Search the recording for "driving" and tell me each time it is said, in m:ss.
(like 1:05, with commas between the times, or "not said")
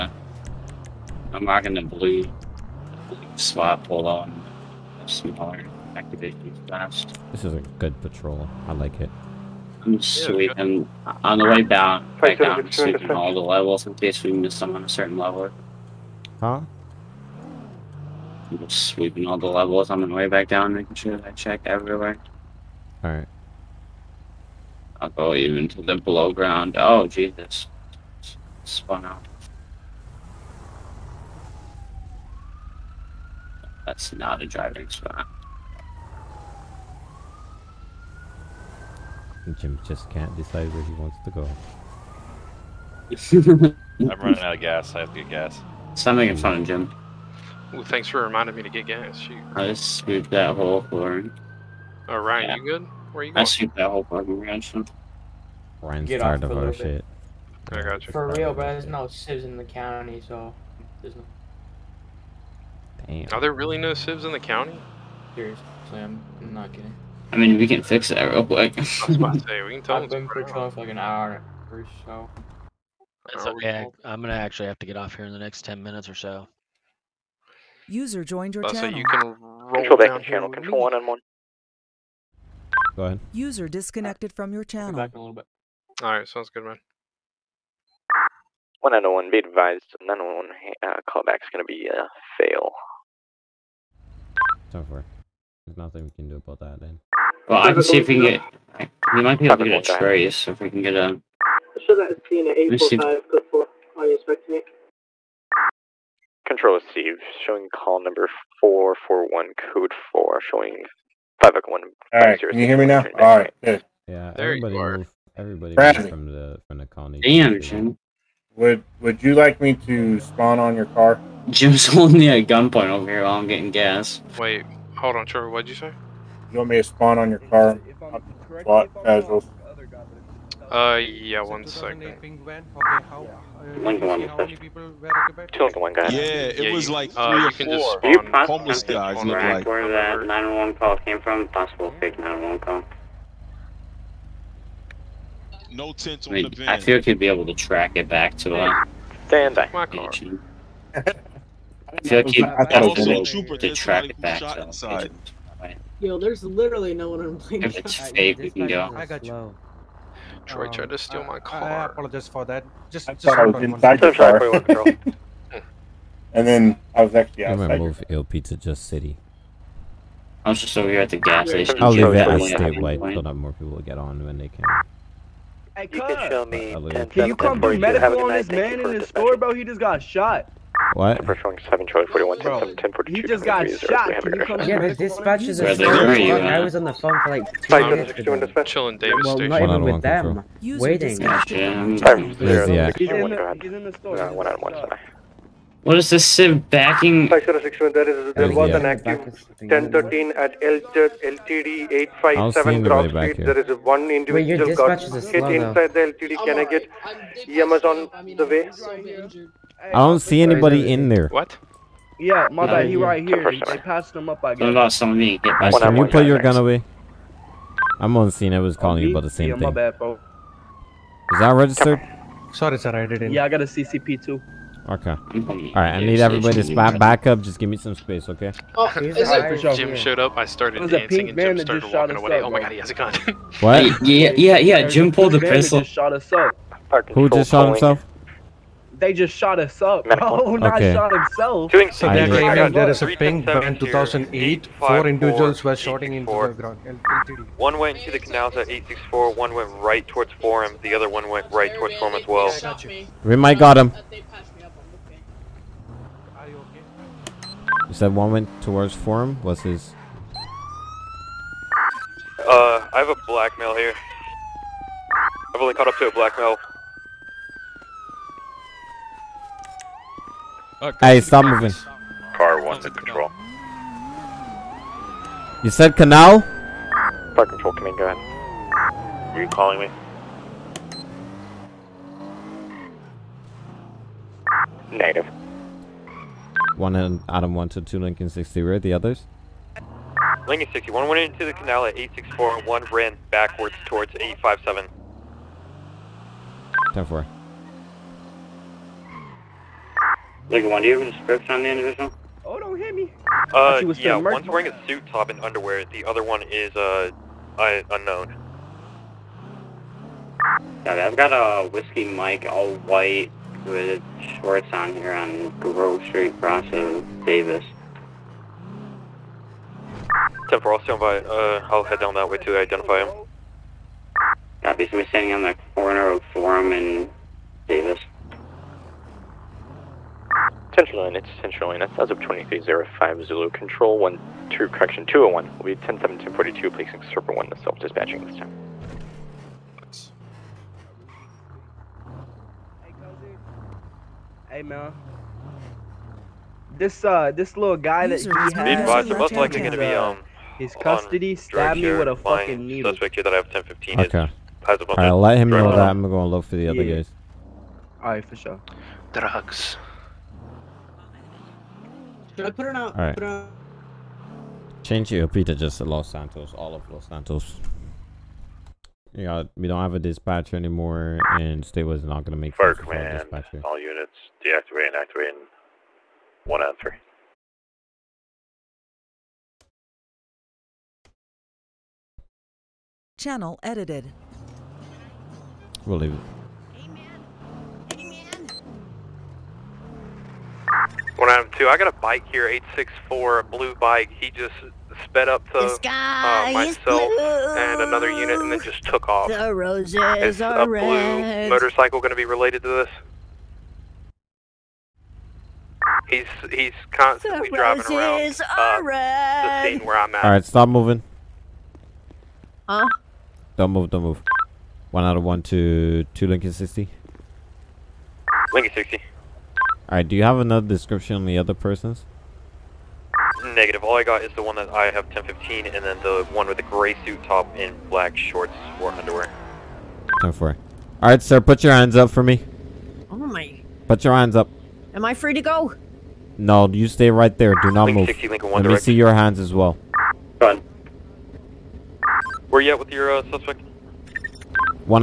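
0:34, 6:47.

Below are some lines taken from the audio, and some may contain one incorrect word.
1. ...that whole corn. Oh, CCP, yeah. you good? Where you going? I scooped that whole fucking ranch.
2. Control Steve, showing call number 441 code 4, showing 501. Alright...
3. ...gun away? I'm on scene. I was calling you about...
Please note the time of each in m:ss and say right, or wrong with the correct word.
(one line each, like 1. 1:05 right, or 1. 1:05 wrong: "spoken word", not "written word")
1. 0:50 wrong: "Ryan", not "CCP"
2. 1:46 right
3. 3:36 right.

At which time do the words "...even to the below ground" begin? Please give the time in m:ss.
0:25.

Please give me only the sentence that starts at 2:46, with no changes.
and then I was actually outside.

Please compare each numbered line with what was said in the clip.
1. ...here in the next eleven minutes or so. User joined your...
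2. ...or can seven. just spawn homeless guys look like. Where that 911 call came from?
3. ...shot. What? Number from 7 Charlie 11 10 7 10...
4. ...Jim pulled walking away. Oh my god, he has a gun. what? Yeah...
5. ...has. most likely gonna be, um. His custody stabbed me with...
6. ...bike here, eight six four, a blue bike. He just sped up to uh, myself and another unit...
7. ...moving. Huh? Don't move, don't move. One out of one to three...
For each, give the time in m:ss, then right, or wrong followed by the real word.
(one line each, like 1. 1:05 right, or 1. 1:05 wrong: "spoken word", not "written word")
1. 1:15 wrong: "ten", not "eleven"
2. 2:17 wrong: "four", not "seven"
3. 3:00 wrong: "41", not "11"
4. 3:51 wrong: "started", not "pulled"
5. 5:48 right
6. 6:31 right
7. 6:50 wrong: "two", not "three".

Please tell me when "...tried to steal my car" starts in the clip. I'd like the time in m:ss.
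2:40.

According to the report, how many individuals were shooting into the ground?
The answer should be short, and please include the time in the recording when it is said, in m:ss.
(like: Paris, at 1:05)
4, at 4:04.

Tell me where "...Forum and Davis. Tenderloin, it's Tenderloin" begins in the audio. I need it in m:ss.
5:26.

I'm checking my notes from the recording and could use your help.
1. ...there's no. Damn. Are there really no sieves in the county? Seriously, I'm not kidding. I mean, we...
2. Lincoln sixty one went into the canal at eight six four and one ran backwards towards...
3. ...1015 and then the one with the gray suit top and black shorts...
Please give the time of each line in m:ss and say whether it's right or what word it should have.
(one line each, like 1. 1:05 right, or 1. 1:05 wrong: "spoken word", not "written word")
1. 1:01 right
2. 4:50 right
3. 7:05 right.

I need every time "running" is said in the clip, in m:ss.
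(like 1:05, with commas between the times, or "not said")
0:44.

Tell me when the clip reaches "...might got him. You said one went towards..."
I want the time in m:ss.
4:13.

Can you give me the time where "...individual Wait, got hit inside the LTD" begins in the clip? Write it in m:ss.
3:24.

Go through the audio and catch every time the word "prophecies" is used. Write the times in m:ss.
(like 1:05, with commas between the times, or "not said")
not said.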